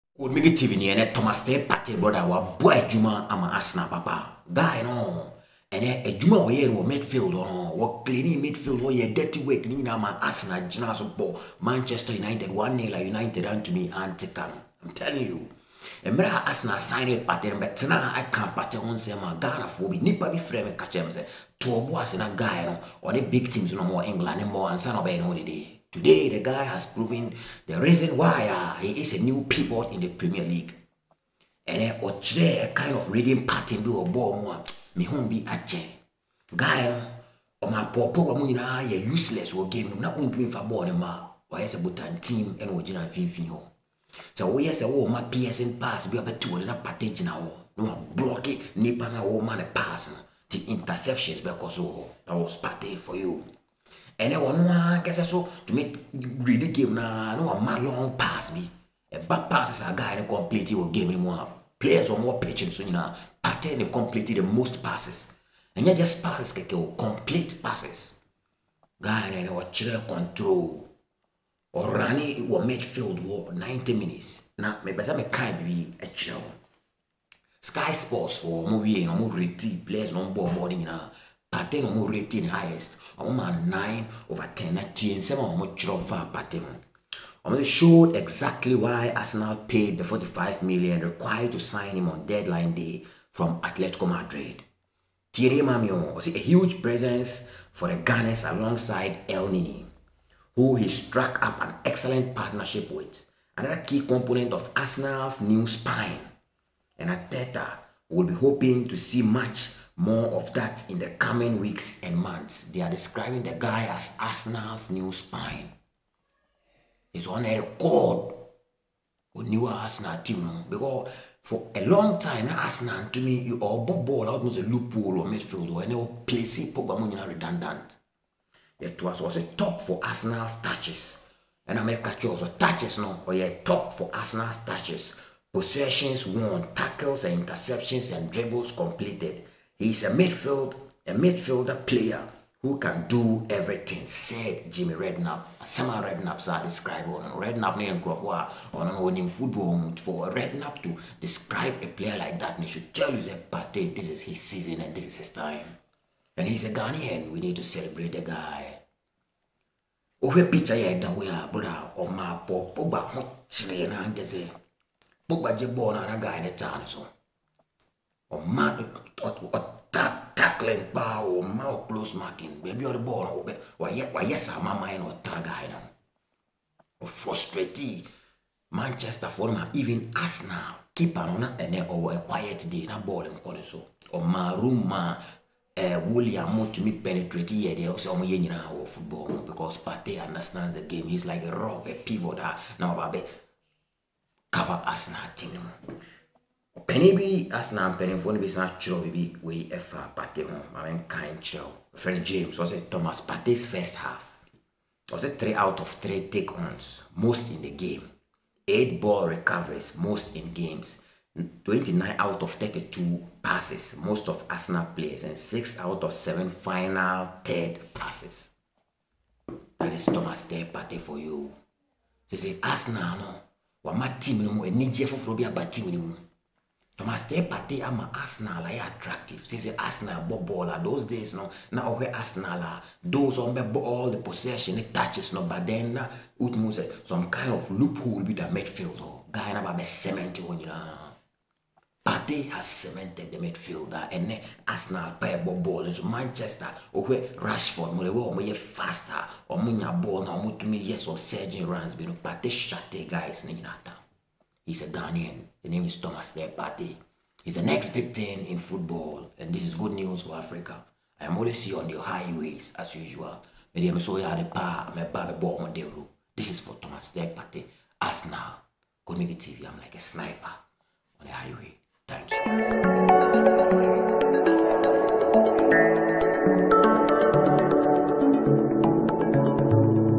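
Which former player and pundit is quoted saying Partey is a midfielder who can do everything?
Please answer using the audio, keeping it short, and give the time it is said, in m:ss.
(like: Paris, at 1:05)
Jamie Redknapp, at 2:24.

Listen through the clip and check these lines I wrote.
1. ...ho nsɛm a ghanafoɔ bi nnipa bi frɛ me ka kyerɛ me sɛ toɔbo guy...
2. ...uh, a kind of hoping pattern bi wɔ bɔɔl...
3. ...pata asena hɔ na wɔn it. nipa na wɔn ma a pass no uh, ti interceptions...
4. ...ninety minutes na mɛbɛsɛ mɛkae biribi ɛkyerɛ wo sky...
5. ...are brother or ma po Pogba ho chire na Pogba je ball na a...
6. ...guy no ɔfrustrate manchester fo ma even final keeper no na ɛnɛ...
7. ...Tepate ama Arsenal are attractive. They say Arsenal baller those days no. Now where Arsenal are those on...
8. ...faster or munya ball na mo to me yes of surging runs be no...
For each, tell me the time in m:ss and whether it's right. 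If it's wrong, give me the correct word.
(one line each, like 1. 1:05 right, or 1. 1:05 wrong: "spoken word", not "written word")
1. 0:18 right
2. 0:32 wrong: "reading", not "hoping"
3. 0:46 wrong: "gyina", not "asena"
4. 1:13 right
5. 2:41 right
6. 2:55 wrong: "arsenal", not "final"
7. 3:47 right
8. 4:08 right.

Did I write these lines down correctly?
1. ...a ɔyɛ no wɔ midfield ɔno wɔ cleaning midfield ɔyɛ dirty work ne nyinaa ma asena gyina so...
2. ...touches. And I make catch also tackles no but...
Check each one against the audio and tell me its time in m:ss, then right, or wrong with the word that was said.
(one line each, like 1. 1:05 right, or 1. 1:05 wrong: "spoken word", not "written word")
1. 0:06 right
2. 2:10 wrong: "touches", not "tackles".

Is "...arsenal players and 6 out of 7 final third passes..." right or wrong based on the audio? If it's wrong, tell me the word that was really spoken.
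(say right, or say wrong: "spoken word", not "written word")
right.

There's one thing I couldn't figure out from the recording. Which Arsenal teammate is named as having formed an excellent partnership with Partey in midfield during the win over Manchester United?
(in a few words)
Elneny.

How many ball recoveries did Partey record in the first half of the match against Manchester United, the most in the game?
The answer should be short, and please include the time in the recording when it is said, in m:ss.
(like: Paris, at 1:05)
8, at 3:28.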